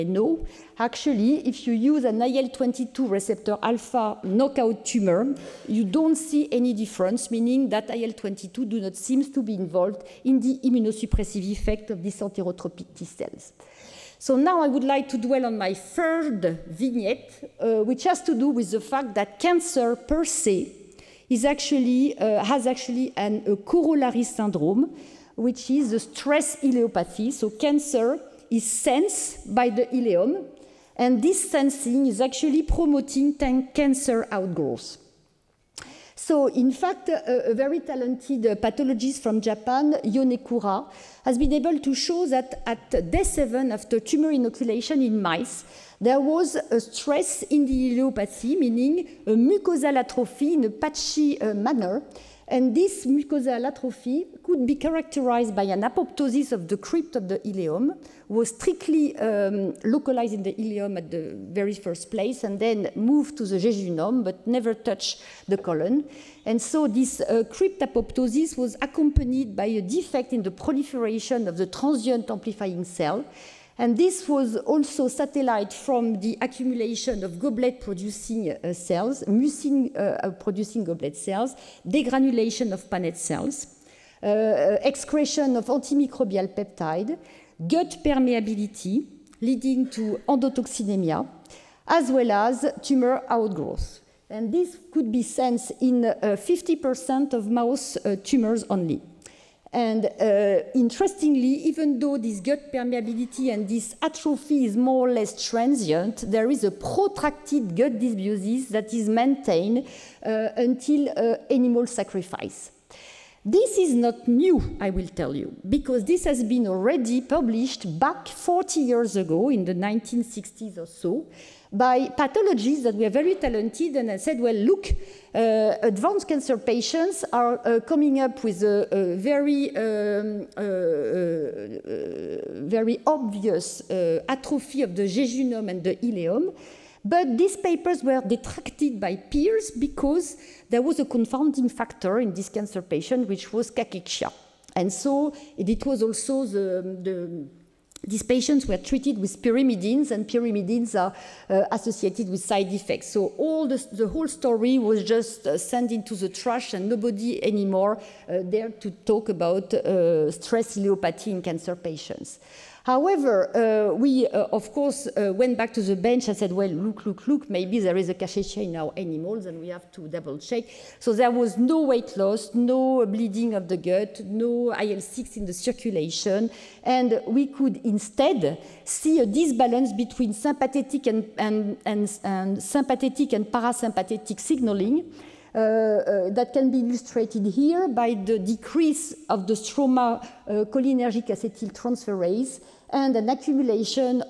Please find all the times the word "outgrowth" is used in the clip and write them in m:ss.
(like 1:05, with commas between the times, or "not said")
0:34, 1:33.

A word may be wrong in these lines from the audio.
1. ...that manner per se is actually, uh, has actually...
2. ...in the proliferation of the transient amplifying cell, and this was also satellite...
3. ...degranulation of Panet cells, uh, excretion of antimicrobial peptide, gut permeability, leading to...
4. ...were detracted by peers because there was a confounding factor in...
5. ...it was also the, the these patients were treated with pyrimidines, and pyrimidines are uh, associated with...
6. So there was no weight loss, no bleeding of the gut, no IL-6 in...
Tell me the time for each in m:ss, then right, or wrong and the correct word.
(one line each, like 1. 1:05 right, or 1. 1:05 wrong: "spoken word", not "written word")
1. 0:19 wrong: "cancer", not "manner"
2. 1:10 right
3. 1:21 right
4. 2:18 right
5. 2:25 right
6. 2:50 right.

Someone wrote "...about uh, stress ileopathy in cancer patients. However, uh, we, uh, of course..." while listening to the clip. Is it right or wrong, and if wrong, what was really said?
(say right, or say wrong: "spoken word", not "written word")
right.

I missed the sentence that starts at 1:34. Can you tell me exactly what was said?
And this could be sensed in 50% of mouse tumors only.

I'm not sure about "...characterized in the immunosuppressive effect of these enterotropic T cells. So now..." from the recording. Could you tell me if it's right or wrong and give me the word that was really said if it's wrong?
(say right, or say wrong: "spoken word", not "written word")
wrong: "involved", not "characterized".